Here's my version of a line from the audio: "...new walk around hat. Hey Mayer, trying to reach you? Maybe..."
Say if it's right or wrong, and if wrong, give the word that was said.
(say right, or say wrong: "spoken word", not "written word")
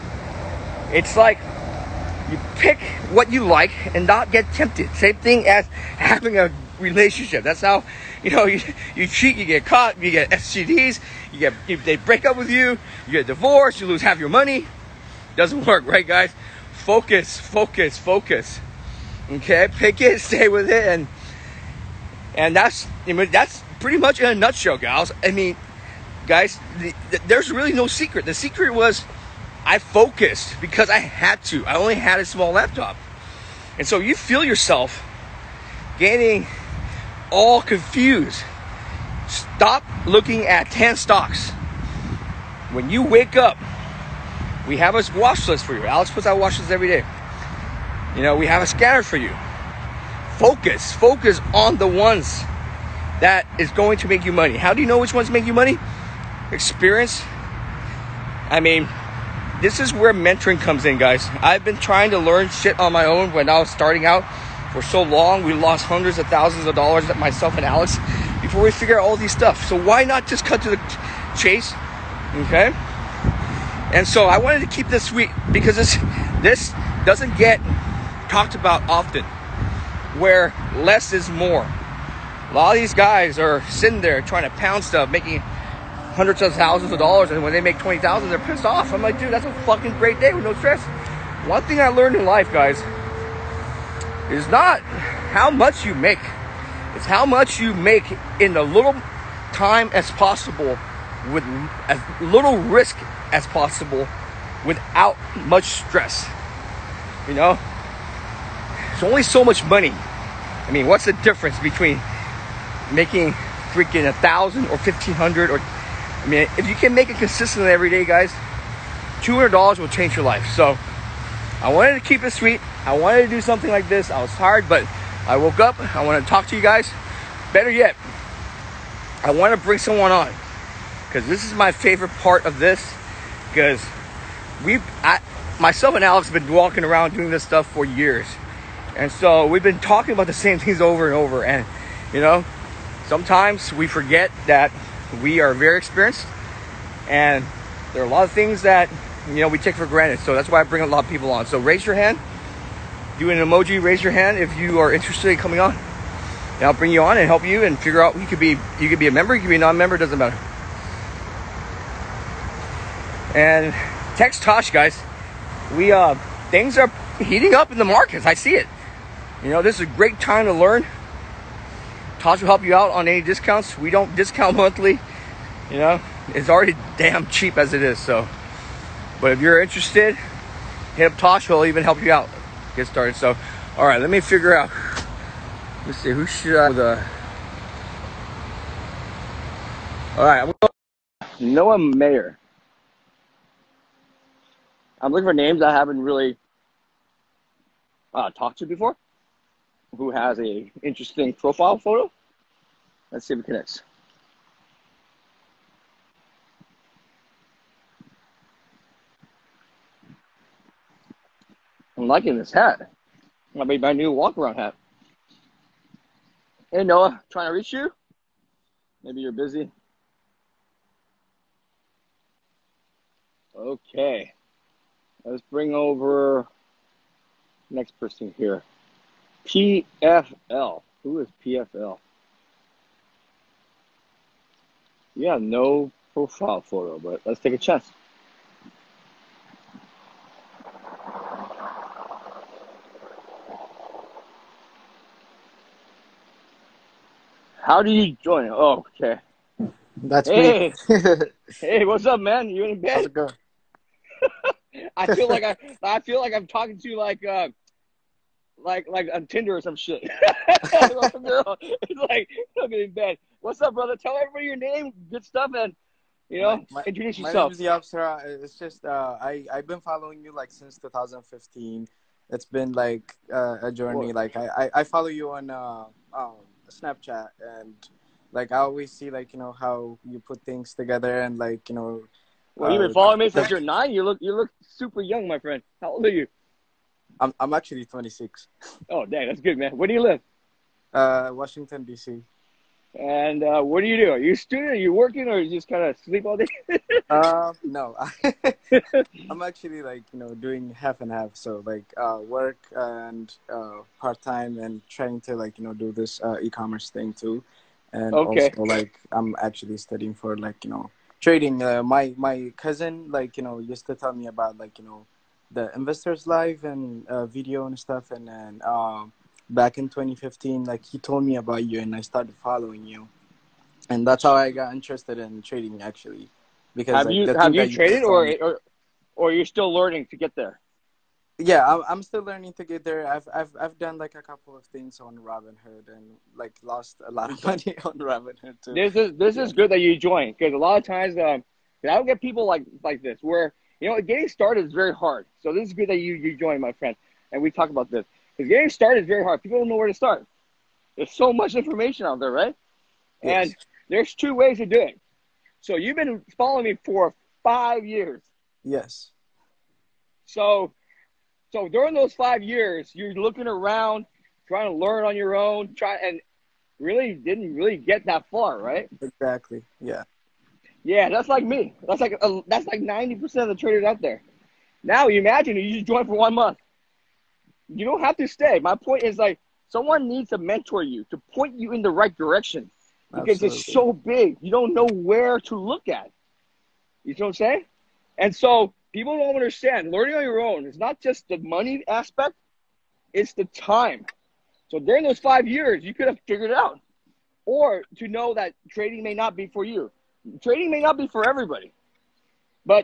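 wrong: "Noah", not "Mayer".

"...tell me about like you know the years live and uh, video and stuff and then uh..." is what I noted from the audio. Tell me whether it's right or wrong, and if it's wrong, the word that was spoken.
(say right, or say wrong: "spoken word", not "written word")
wrong: "investors", not "years".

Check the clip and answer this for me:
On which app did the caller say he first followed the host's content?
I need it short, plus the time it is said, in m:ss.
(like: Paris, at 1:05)
Snapchat, at 4:36.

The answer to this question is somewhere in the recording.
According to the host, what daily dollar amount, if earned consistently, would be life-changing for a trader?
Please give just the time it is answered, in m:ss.
1:59.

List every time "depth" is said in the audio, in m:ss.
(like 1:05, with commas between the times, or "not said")
not said.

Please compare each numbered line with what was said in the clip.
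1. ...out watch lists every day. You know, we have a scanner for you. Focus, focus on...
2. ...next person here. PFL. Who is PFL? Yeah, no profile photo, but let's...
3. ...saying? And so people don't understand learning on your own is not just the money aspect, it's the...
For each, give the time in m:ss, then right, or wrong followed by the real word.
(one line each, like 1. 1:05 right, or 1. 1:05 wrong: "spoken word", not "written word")
1. 0:46 right
2. 3:47 right
3. 6:27 right.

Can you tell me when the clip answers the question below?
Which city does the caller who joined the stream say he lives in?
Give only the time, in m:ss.
4:51.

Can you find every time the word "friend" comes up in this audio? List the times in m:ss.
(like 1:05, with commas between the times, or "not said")
4:45, 5:46.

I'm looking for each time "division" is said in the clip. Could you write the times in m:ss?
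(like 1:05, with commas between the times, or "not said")
not said.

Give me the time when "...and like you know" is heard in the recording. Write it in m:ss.
4:41.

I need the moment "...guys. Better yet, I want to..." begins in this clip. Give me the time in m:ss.
2:06.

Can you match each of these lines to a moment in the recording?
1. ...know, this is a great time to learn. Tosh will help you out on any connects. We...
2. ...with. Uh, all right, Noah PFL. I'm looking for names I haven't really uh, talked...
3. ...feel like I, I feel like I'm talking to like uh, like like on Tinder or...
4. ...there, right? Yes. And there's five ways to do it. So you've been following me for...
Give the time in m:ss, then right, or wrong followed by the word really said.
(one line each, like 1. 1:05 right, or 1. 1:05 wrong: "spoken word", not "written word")
1. 2:49 wrong: "discounts", not "connects"
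2. 3:06 wrong: "Mayer", not "PFL"
3. 4:15 right
4. 5:52 wrong: "two", not "five".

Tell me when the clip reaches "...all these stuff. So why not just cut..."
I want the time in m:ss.
1:09.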